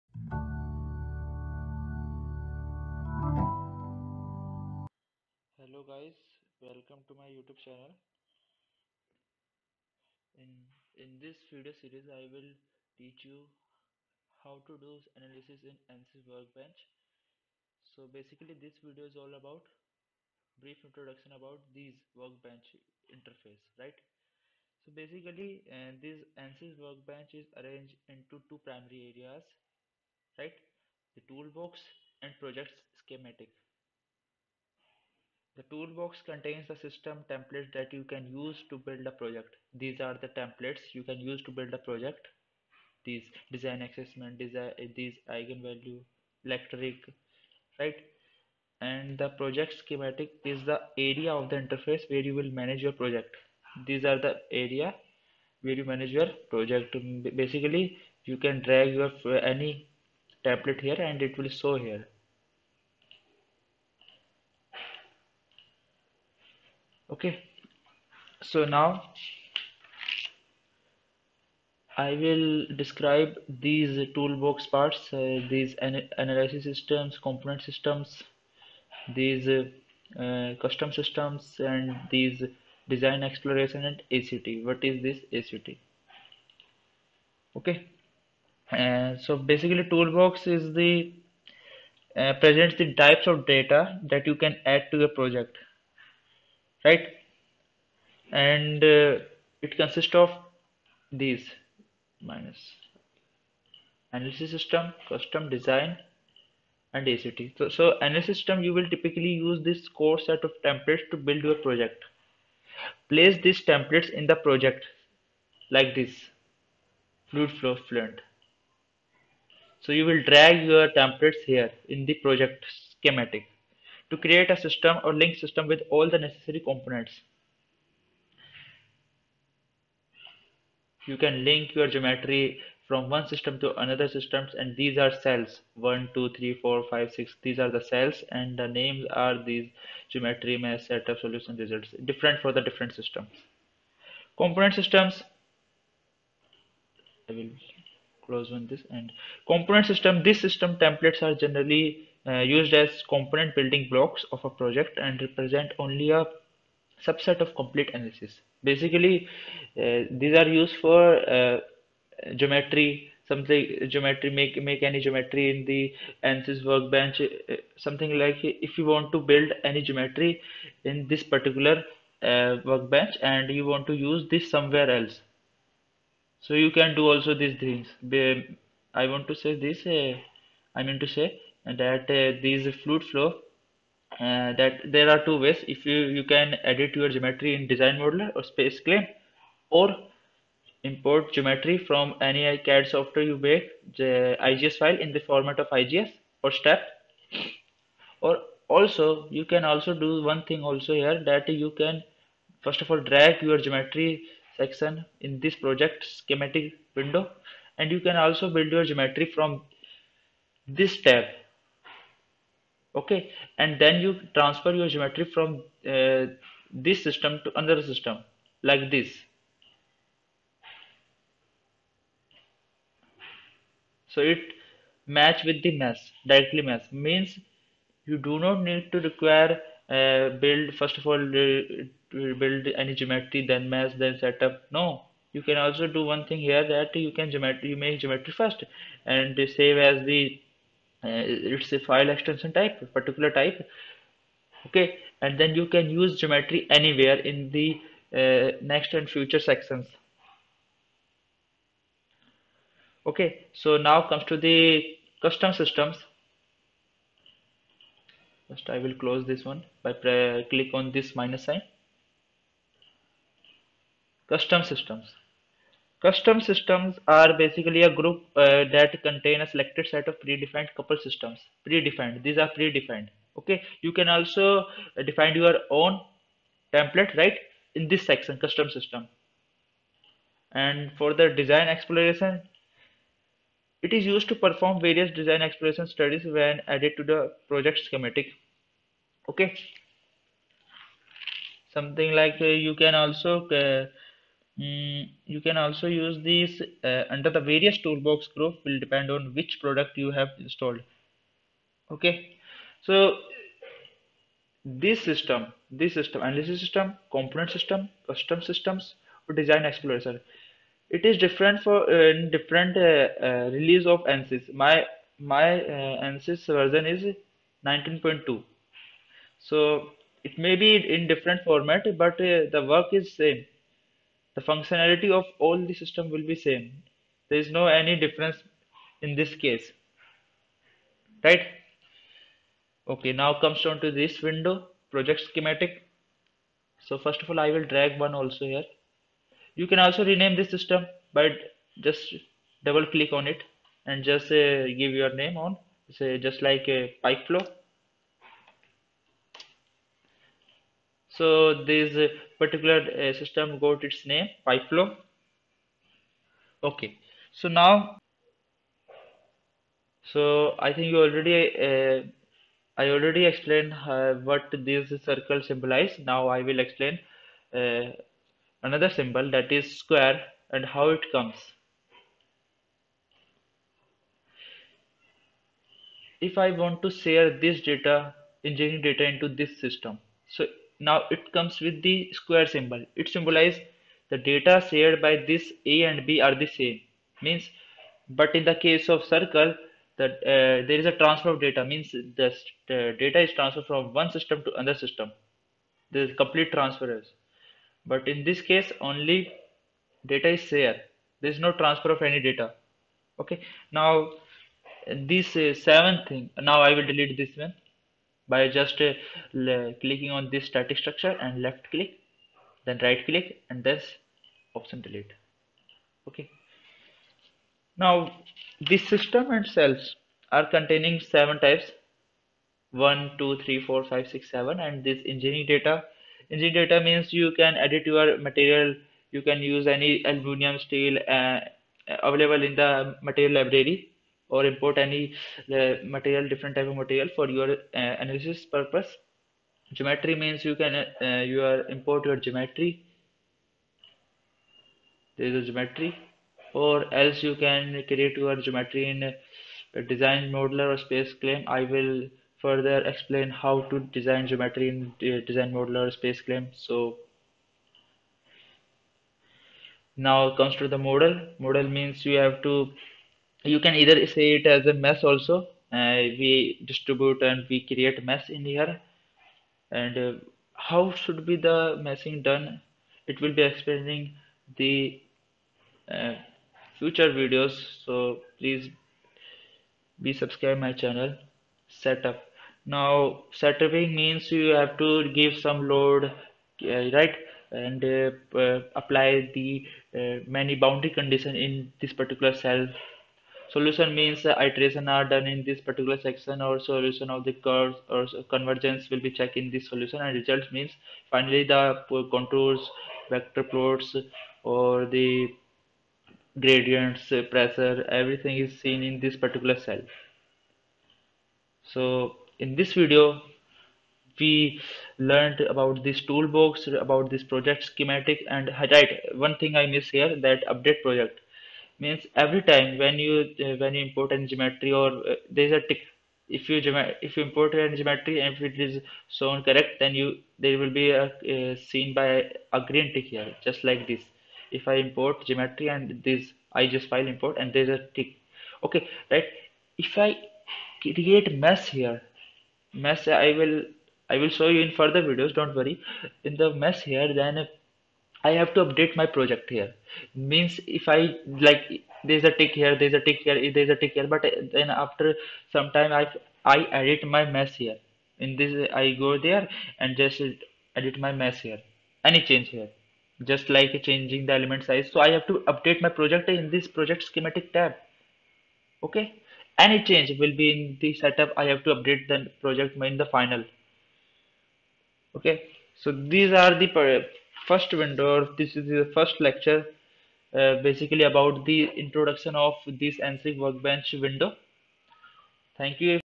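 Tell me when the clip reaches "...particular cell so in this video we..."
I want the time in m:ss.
8:29.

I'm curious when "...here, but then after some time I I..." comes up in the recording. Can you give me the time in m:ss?
9:13.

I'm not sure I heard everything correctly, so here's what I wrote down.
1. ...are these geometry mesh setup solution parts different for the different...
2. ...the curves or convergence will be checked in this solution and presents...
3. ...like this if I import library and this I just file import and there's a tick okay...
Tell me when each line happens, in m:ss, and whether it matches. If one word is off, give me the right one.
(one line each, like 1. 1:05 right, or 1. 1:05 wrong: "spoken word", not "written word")
1. 2:19 wrong: "results", not "parts"
2. 8:17 wrong: "results", not "presents"
3. 8:53 wrong: "geometry", not "library".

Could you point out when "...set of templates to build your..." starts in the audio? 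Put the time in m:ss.
1:50.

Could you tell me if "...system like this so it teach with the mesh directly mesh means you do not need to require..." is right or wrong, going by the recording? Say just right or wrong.
wrong.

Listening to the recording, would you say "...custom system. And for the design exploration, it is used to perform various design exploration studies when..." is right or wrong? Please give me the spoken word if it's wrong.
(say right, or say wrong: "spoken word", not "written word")
right.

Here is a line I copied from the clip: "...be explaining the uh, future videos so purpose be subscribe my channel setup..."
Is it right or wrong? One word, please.
wrong.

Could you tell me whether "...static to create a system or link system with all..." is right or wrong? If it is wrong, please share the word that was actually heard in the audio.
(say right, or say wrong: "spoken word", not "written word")
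wrong: "schematic", not "static".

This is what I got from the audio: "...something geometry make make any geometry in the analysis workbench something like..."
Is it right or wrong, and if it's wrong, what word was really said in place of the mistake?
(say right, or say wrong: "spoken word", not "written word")
right.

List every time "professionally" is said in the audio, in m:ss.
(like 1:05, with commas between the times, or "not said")
not said.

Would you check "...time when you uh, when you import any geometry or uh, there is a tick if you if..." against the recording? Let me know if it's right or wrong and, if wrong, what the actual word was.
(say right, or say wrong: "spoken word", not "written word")
right.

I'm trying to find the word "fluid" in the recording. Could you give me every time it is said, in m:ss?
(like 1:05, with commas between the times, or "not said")
1:57, 3:02.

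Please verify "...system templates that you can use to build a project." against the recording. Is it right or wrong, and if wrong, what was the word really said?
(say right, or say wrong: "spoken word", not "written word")
right.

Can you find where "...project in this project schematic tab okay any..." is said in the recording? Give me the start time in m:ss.
9:25.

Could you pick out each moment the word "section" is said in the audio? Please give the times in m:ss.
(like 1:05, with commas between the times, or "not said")
3:24, 4:09, 4:38, 8:16.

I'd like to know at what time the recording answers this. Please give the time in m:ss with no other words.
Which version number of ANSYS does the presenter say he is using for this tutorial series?
5:17.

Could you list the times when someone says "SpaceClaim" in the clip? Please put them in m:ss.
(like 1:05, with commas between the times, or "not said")
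3:08, 7:30, 7:35.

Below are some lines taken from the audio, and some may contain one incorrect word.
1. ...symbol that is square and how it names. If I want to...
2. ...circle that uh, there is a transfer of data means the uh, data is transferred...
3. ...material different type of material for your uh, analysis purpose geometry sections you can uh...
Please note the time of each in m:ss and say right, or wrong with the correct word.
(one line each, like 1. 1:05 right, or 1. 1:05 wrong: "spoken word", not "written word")
1. 6:08 wrong: "comes", not "names"
2. 6:29 right
3. 7:15 wrong: "means", not "sections".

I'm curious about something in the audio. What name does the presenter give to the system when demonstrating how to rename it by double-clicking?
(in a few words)
Pipe flow.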